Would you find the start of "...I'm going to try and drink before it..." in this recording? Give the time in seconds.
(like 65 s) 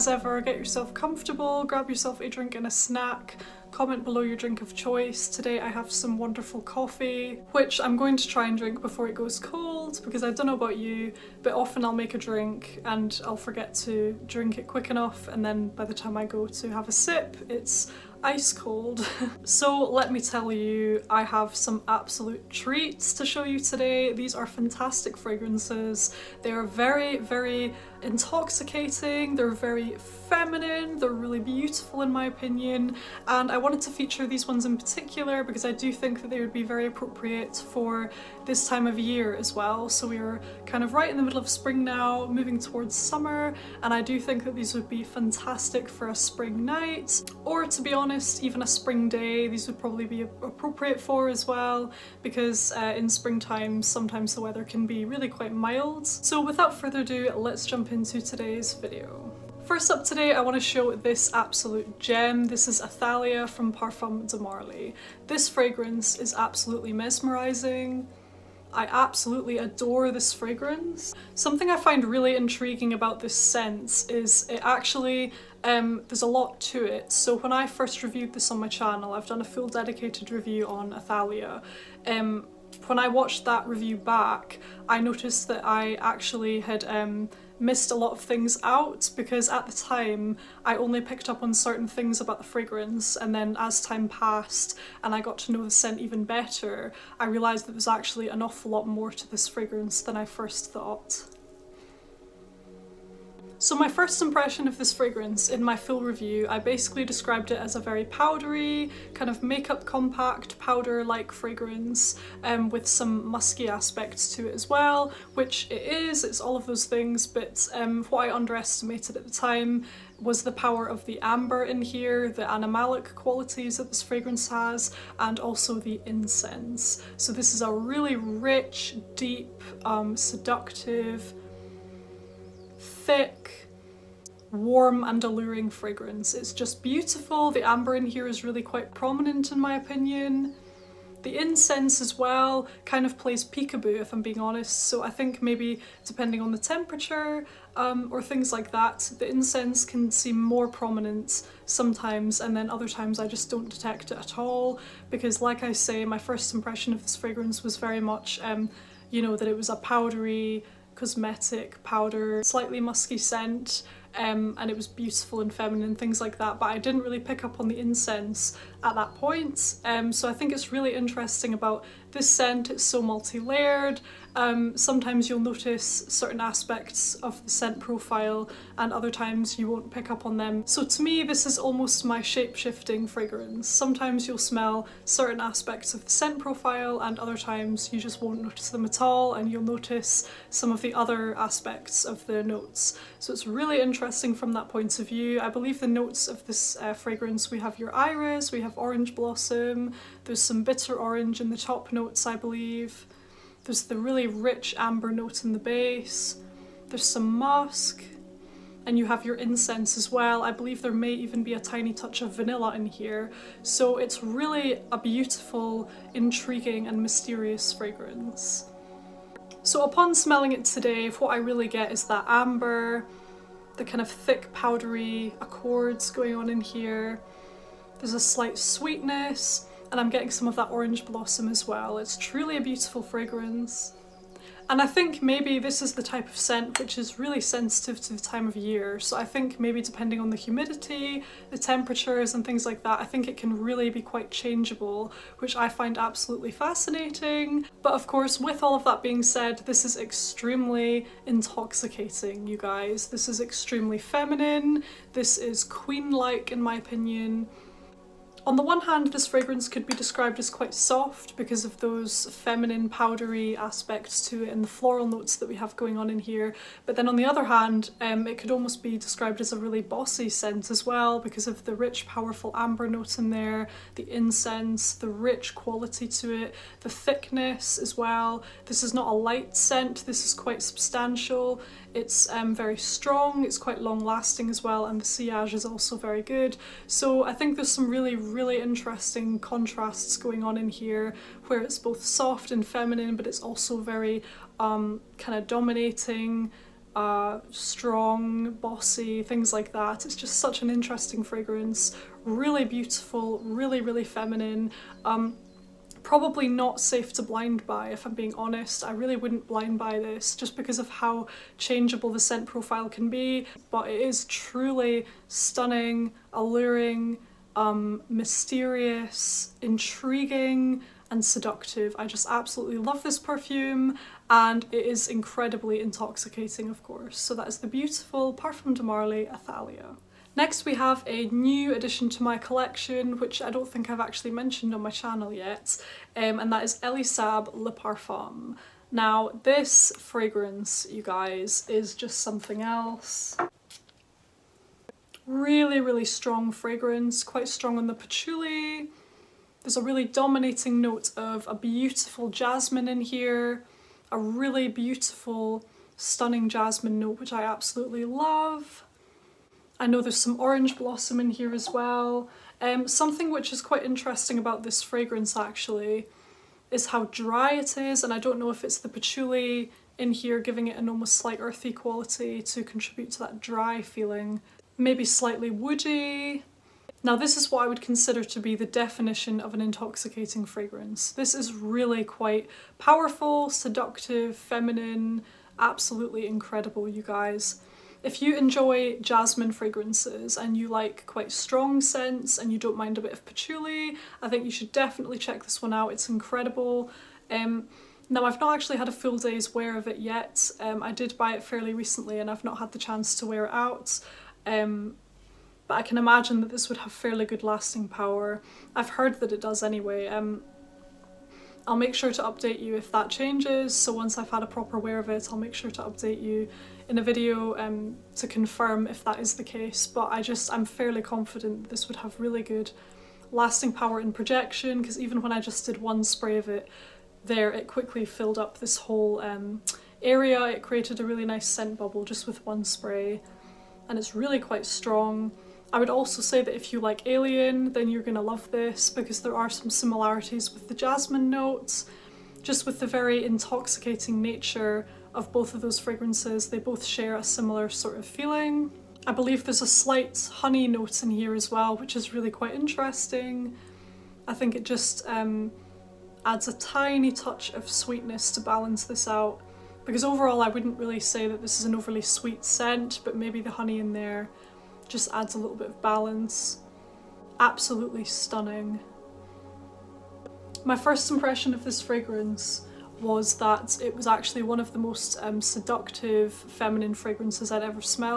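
7 s.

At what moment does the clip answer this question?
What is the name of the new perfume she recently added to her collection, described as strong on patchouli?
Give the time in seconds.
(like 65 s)
336 s.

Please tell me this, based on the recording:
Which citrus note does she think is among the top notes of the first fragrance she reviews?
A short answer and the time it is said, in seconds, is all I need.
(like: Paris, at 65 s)
Bitter orange, at 200 s.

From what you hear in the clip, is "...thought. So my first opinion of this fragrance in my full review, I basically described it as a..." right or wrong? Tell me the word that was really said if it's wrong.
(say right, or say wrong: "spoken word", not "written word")
wrong: "impression", not "opinion".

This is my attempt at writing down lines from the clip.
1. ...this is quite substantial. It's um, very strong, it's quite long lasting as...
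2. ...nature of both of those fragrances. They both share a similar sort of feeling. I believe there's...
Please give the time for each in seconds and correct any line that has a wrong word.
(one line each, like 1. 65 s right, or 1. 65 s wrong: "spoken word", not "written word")
1. 280 s right
2. 444 s right.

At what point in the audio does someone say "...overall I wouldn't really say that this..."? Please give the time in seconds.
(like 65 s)
460 s.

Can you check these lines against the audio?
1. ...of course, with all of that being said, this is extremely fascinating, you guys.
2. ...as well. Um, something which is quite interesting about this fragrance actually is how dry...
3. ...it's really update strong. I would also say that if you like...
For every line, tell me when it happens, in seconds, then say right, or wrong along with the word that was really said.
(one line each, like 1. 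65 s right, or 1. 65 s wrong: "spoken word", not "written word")
1. 247 s wrong: "intoxicating", not "fascinating"
2. 361 s right
3. 433 s wrong: "quite", not "update".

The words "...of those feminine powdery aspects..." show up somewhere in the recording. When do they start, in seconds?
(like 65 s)
261 s.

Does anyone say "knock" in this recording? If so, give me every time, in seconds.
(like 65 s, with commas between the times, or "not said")
not said.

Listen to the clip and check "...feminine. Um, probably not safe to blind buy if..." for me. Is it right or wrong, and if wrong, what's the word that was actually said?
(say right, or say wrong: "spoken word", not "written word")
right.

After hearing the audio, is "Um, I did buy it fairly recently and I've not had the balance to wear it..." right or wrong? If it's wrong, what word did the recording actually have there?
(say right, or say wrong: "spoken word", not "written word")
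wrong: "chance", not "balance".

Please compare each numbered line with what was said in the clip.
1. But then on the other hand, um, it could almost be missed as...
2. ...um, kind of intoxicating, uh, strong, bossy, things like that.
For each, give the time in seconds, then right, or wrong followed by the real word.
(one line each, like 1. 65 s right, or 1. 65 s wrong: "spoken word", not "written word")
1. 266 s wrong: "described", not "missed"
2. 294 s wrong: "dominating", not "intoxicating".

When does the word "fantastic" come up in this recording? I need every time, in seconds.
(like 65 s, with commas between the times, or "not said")
24 s, 45 s.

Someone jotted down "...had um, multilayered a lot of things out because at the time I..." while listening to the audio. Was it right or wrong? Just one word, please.
wrong.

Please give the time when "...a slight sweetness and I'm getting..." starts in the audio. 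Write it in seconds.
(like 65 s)
228 s.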